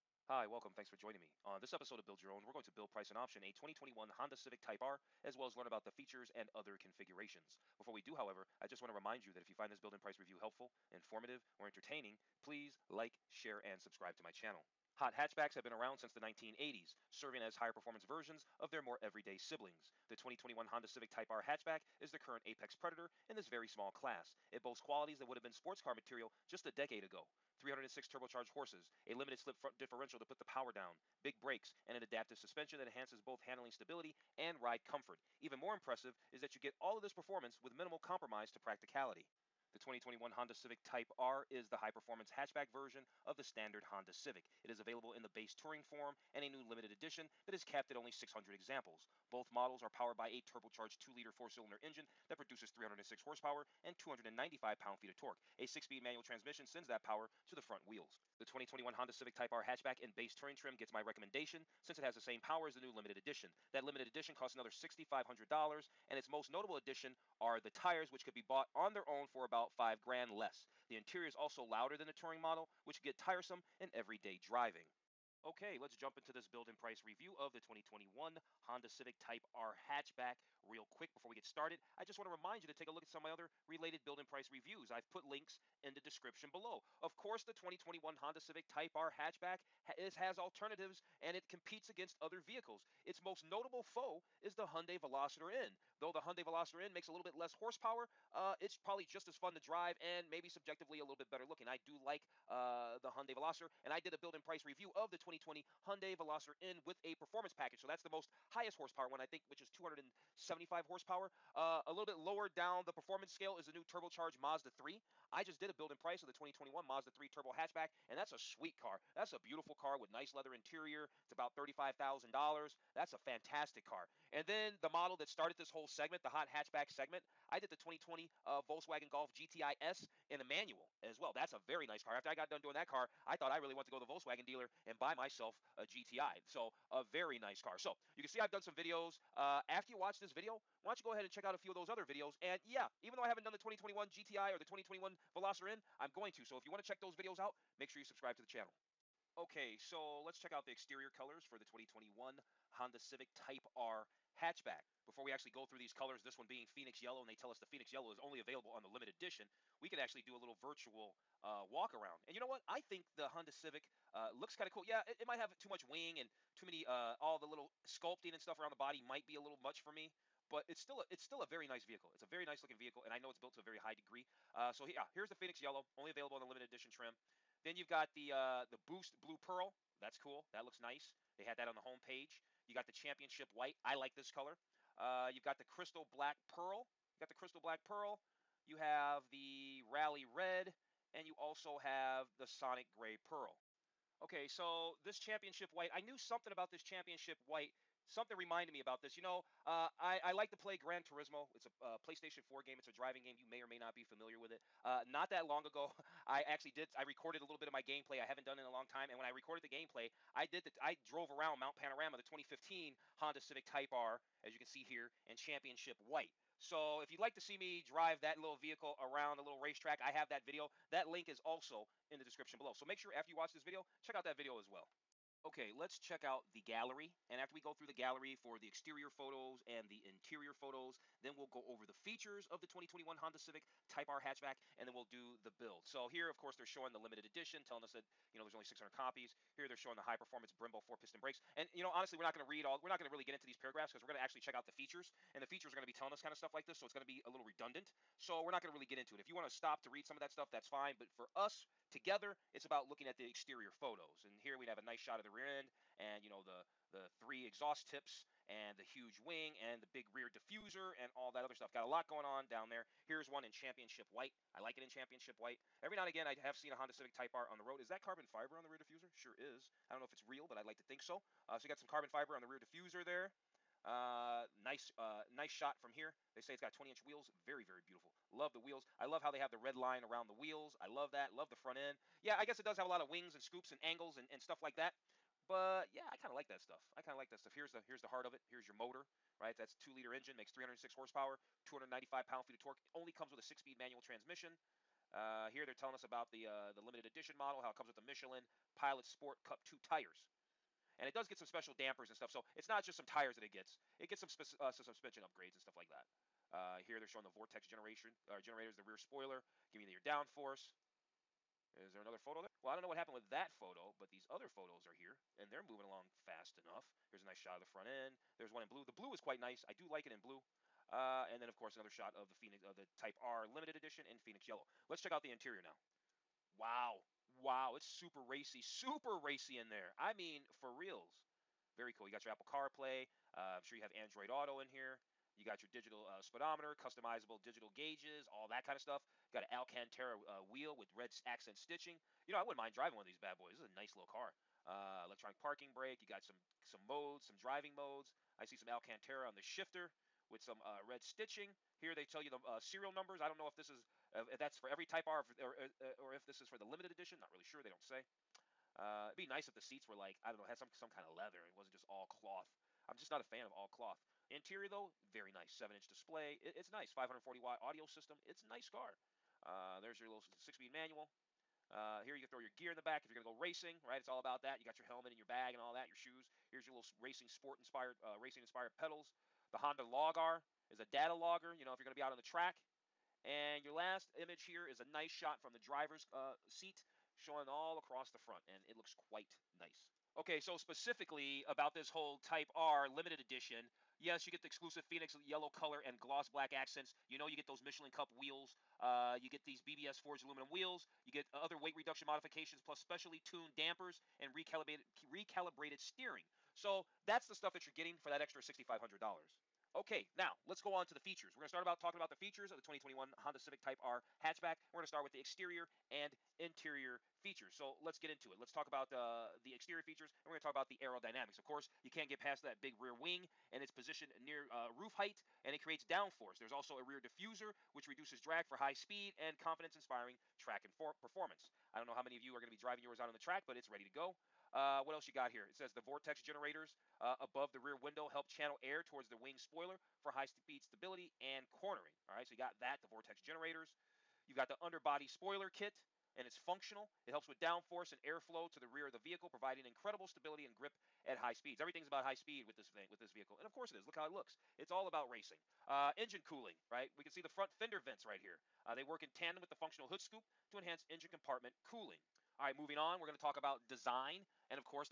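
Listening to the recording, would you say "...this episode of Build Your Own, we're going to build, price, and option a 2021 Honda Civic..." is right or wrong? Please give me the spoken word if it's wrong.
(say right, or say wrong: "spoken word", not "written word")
right.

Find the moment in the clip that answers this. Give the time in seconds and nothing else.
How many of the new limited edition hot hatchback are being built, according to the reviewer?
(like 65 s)
48 s.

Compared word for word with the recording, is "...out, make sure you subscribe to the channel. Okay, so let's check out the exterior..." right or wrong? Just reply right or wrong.
right.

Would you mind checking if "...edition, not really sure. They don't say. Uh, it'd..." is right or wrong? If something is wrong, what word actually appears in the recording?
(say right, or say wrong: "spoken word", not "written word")
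right.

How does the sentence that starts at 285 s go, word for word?
But yeah, I kind of like that stuff.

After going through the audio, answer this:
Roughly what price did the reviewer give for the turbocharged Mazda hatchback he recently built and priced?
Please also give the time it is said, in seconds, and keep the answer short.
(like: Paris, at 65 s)
$35,000, at 121 s.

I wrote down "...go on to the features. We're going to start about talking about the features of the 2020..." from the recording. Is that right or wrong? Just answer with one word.
wrong.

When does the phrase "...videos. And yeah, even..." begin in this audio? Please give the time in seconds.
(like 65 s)
142 s.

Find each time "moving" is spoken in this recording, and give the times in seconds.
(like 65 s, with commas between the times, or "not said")
315 s, 462 s.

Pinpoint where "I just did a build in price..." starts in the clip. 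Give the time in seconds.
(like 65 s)
115 s.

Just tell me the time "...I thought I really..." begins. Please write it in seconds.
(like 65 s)
133 s.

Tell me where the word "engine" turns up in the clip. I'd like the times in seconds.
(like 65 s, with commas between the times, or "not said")
51 s, 290 s, 455 s, 460 s.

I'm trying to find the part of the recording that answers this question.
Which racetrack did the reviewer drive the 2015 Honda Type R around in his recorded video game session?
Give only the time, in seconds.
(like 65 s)
211 s.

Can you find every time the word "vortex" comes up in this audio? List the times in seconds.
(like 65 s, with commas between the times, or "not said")
307 s, 435 s, 442 s.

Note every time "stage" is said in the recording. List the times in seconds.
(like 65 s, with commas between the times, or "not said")
not said.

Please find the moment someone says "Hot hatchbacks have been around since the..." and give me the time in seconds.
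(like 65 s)
14 s.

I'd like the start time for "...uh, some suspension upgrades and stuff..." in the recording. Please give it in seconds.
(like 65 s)
304 s.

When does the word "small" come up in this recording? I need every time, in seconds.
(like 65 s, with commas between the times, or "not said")
23 s.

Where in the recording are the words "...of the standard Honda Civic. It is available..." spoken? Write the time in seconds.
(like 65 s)
43 s.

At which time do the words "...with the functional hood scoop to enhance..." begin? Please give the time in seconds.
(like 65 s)
459 s.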